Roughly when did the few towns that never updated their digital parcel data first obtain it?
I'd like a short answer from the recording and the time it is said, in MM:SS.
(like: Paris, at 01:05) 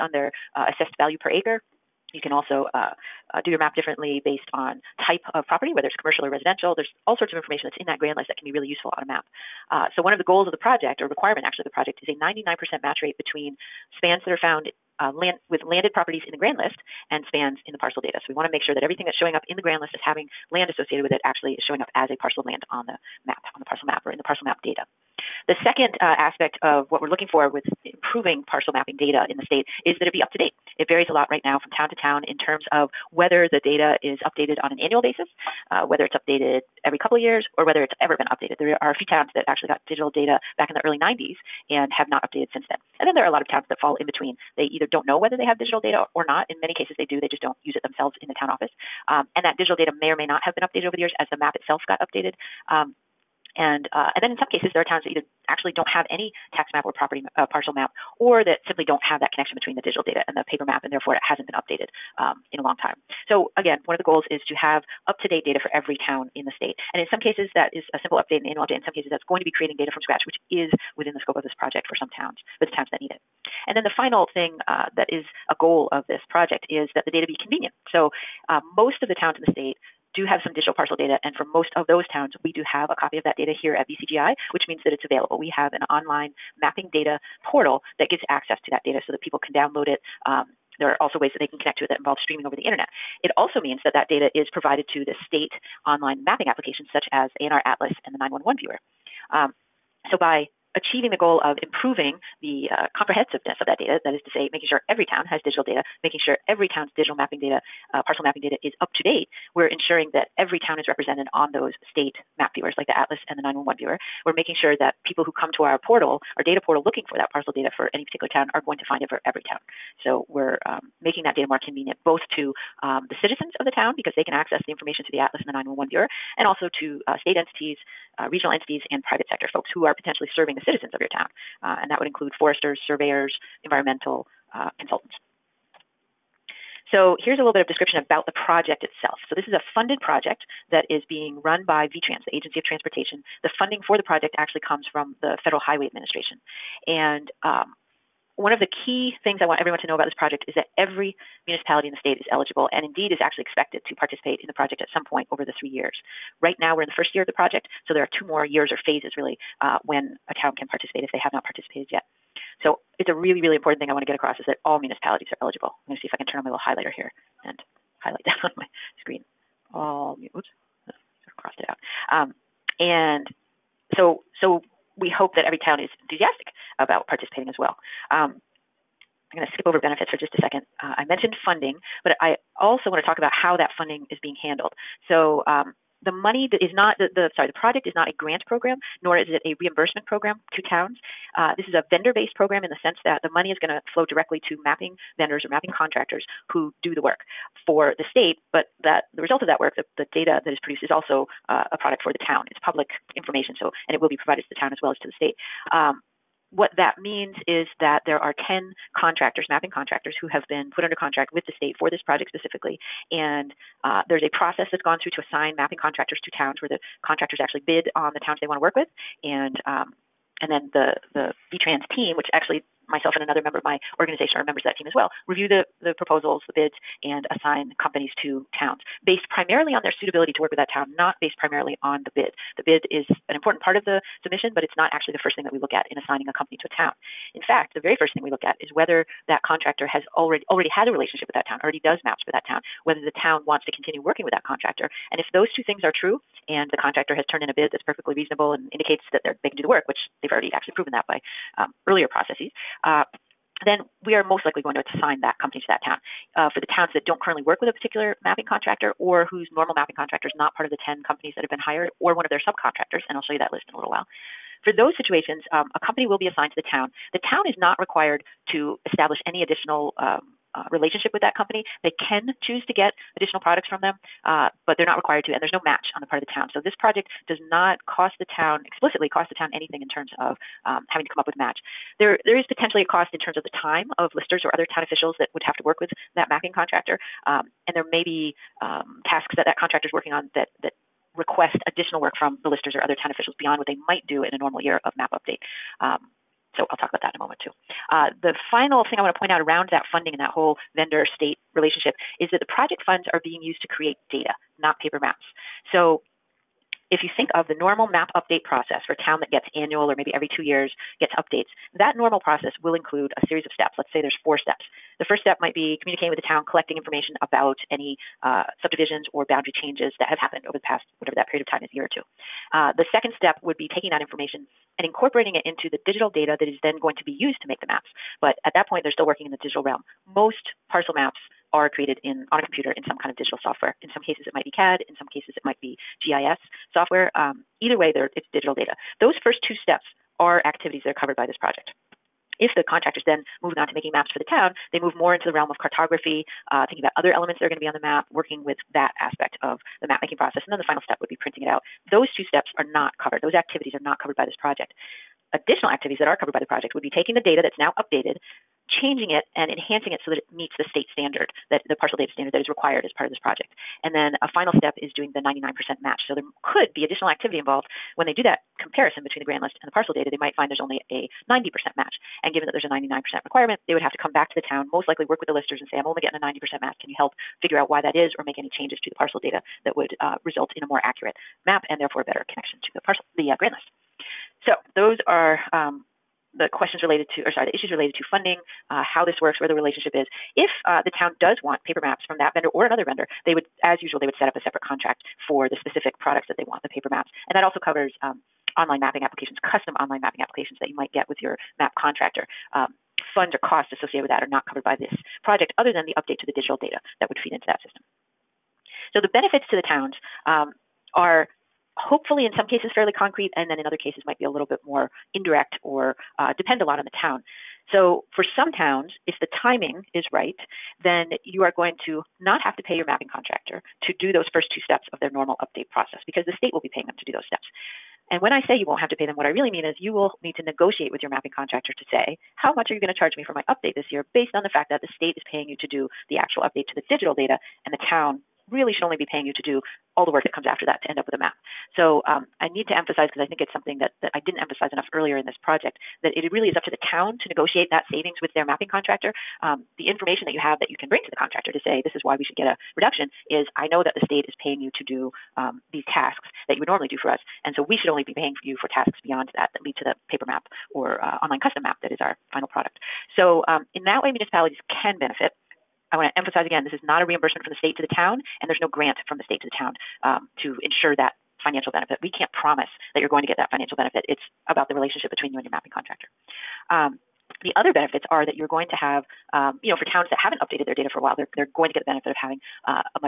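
early 90s, at 00:40.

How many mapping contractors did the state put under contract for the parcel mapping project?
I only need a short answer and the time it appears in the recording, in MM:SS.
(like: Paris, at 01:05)
10, at 03:28.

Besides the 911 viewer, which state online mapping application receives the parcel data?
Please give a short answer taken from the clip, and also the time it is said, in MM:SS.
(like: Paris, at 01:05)
ANR Atlas, at 01:37.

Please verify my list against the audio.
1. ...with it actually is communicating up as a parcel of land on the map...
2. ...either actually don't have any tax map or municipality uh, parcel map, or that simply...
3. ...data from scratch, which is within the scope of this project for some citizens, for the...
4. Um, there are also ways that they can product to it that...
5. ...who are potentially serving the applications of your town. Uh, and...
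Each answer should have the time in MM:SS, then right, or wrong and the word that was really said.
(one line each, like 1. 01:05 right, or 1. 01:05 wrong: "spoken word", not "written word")
1. 00:21 wrong: "showing", not "communicating"
2. 00:55 wrong: "property", not "municipality"
3. 01:09 wrong: "towns", not "citizens"
4. 01:30 wrong: "connect", not "product"
5. 02:09 wrong: "citizens", not "applications".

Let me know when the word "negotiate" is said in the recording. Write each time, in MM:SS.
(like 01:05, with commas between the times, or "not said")
07:10, 07:27.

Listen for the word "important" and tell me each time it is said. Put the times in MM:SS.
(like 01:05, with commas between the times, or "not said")
02:43, 03:53.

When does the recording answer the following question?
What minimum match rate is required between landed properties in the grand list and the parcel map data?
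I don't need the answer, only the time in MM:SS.
00:12.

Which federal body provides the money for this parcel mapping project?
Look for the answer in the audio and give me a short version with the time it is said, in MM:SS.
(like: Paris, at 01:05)
Federal Highway Administration, at 02:25.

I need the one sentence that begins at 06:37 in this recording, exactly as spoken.
And that also covers um, online mapping applications, custom online mapping applications that you might get with your map contractor.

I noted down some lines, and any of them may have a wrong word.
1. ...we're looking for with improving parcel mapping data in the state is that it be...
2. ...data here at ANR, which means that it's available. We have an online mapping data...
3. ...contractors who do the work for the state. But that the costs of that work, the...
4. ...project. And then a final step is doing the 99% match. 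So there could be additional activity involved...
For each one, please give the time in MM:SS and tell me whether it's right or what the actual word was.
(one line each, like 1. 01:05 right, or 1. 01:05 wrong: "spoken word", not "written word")
1. 00:26 right
2. 01:23 wrong: "VCGI", not "ANR"
3. 03:15 wrong: "results", not "costs"
4. 06:03 right.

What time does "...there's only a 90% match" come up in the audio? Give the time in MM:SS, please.
06:10.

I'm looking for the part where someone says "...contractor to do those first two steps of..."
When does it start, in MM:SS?
07:03.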